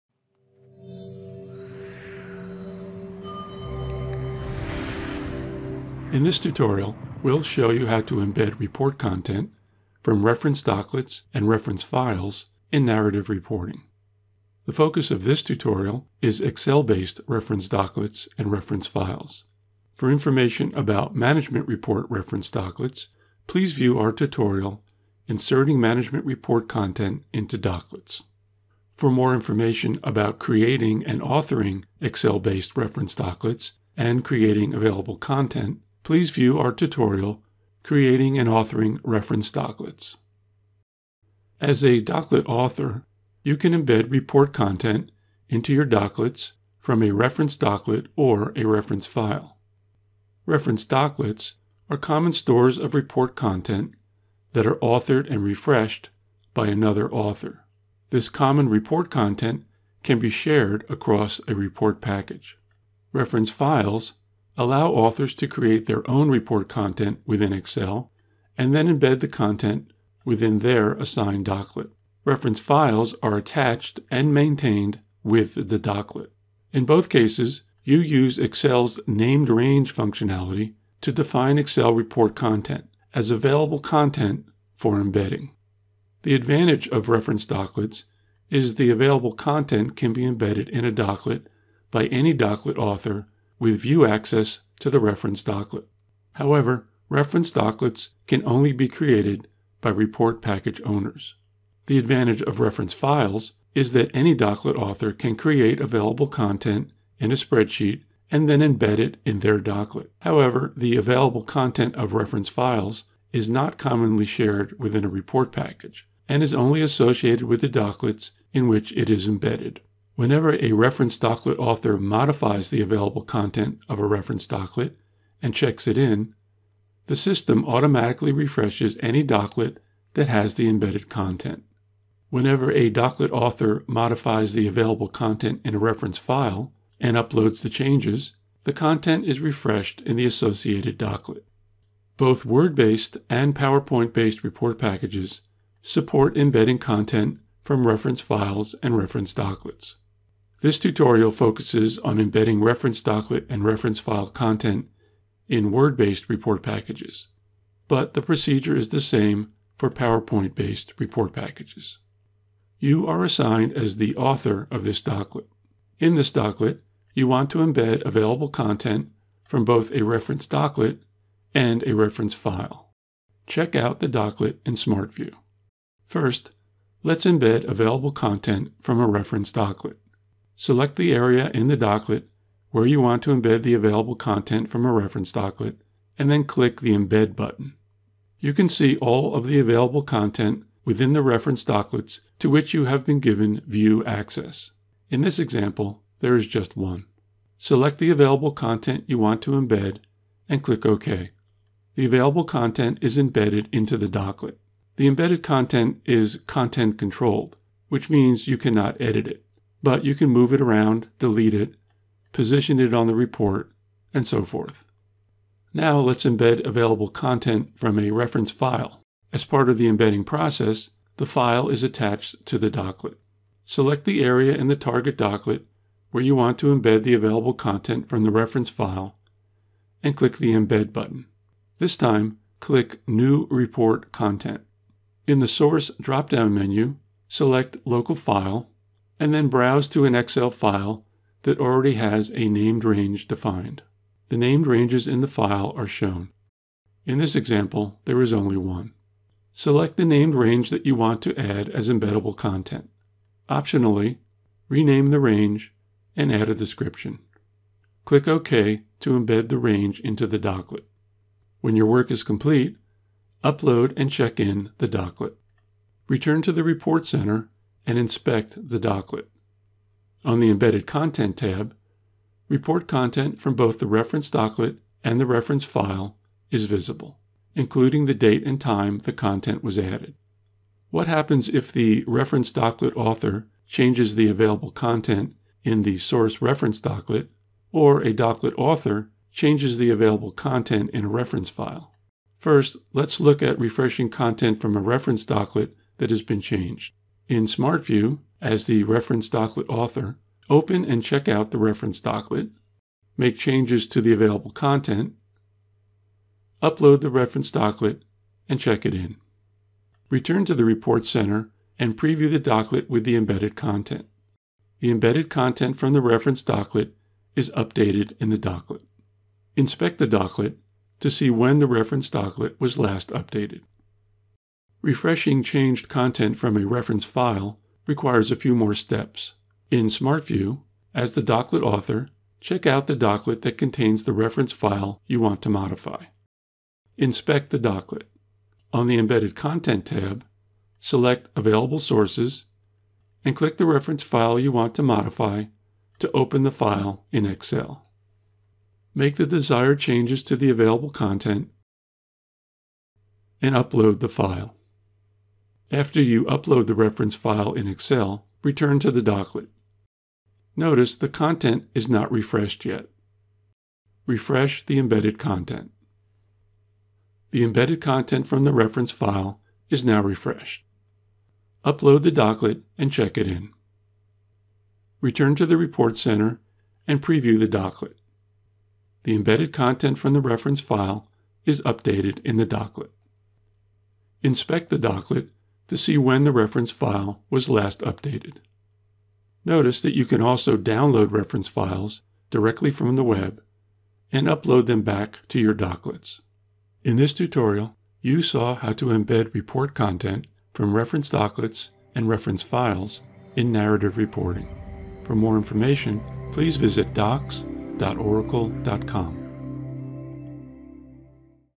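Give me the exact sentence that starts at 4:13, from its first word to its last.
Optionally, rename the range and add a description.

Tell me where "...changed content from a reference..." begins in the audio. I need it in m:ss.
5:25.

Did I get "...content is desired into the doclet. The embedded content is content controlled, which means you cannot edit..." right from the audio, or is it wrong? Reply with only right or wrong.
wrong.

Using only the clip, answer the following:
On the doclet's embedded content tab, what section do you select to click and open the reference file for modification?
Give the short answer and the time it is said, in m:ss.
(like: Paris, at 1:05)
Available Sources, at 5:41.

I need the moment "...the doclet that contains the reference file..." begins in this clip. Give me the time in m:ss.
5:32.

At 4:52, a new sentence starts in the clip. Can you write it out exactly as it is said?
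First, let's look at refreshing content from a reference doclet that has been changed.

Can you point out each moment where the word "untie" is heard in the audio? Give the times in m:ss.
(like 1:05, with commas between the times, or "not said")
not said.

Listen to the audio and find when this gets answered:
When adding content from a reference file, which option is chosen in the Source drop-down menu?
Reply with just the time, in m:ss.
3:57.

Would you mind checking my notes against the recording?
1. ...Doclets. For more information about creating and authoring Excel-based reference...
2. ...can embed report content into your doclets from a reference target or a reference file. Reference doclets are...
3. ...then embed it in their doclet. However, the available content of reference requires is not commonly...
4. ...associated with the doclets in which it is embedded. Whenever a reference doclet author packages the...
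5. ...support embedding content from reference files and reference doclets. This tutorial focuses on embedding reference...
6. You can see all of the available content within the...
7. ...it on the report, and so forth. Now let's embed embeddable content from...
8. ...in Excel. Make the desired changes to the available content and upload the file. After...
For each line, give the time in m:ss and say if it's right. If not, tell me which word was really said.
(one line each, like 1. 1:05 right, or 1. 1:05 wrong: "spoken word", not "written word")
1. 0:27 right
2. 0:43 wrong: "doclet", not "target"
3. 1:48 wrong: "files", not "requires"
4. 1:56 wrong: "modifies", not "packages"
5. 2:25 right
6. 3:08 right
7. 3:32 wrong: "available", not "embeddable"
8. 5:47 right.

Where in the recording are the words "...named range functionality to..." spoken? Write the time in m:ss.
1:19.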